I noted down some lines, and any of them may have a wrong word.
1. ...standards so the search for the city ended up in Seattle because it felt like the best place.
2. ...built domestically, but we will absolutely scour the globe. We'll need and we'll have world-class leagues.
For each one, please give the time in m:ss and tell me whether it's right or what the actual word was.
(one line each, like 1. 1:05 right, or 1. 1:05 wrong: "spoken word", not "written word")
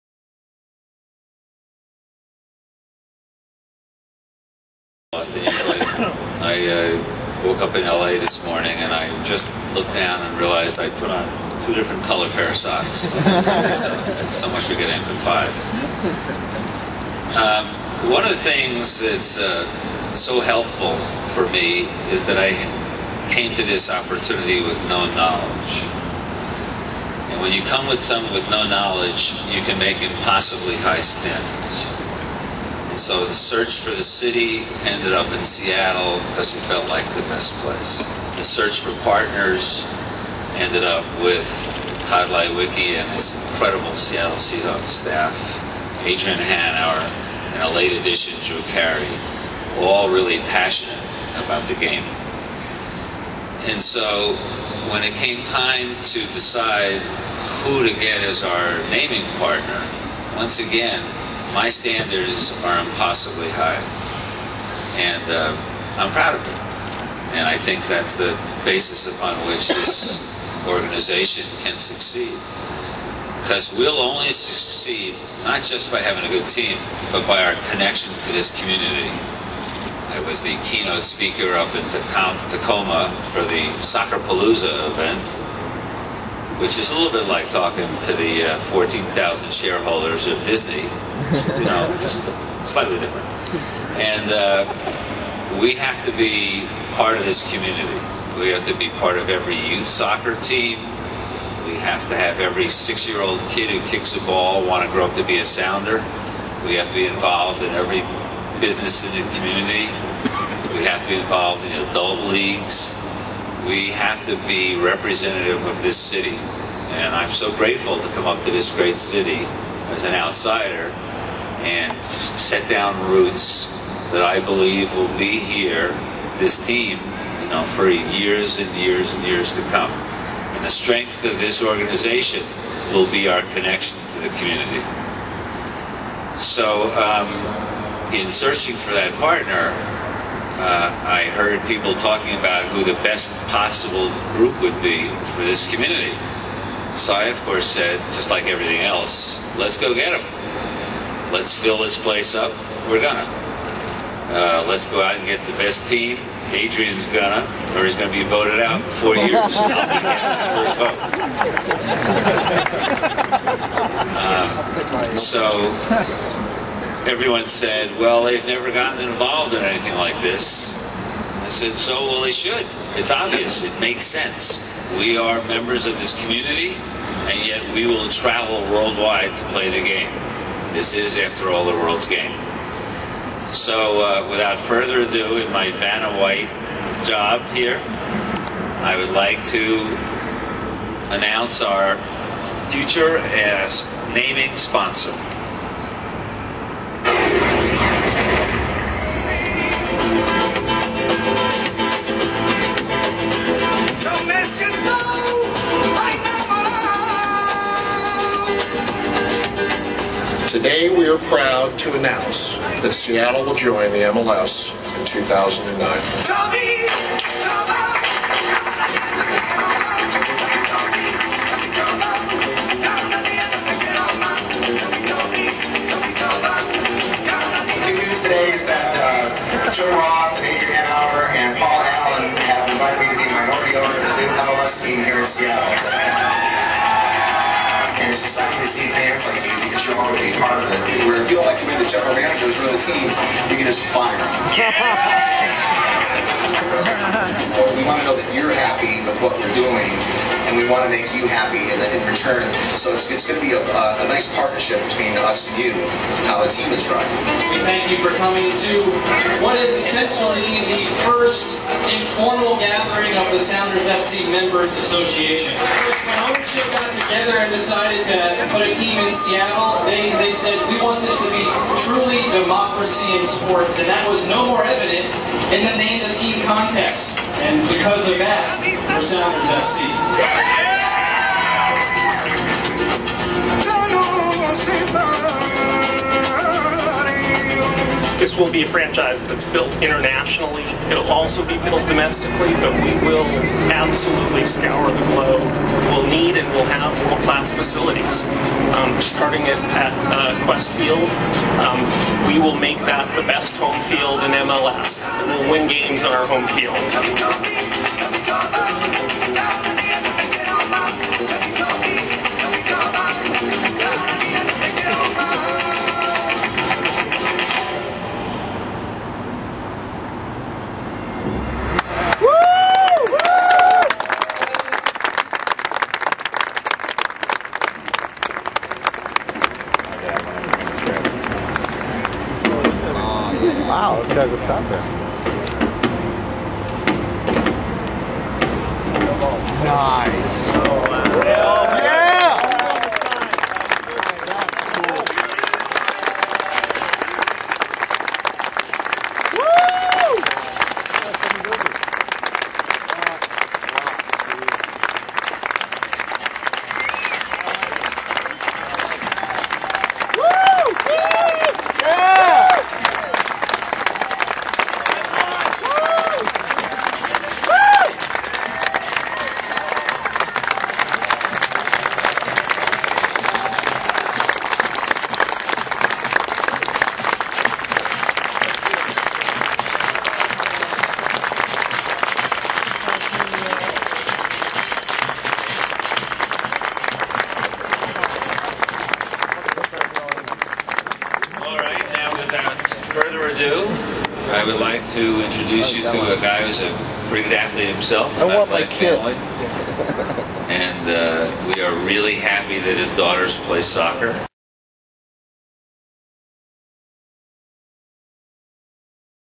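1. 0:31 right
2. 4:51 wrong: "facilities", not "leagues".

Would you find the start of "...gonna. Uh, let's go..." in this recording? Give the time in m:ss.
2:33.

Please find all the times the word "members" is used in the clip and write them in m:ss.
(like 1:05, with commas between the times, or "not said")
2:55, 4:24.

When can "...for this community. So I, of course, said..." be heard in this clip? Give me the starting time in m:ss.
2:25.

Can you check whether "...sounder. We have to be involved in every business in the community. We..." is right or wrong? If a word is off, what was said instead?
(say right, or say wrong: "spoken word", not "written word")
right.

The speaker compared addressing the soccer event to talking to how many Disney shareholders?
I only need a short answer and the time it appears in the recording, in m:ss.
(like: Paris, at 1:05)
14,000, at 1:28.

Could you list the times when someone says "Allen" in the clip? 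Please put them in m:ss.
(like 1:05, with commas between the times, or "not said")
3:51.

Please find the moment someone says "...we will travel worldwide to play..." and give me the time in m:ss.
2:57.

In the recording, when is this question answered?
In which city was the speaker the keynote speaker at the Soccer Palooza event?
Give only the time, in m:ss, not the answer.
1:21.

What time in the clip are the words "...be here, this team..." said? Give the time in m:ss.
2:05.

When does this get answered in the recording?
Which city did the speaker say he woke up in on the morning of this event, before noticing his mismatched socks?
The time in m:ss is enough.
0:07.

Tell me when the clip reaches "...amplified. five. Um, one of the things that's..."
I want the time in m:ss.
0:14.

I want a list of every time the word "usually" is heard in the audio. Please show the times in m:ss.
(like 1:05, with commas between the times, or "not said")
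0:05.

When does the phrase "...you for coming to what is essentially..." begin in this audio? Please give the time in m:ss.
4:17.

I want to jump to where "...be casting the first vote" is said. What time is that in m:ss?
2:39.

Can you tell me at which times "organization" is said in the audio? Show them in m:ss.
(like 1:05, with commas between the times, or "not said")
1:10, 2:11.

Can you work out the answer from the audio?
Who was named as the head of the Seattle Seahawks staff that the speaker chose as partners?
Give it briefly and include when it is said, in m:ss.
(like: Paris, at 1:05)
Tod Leiweke, at 0:42.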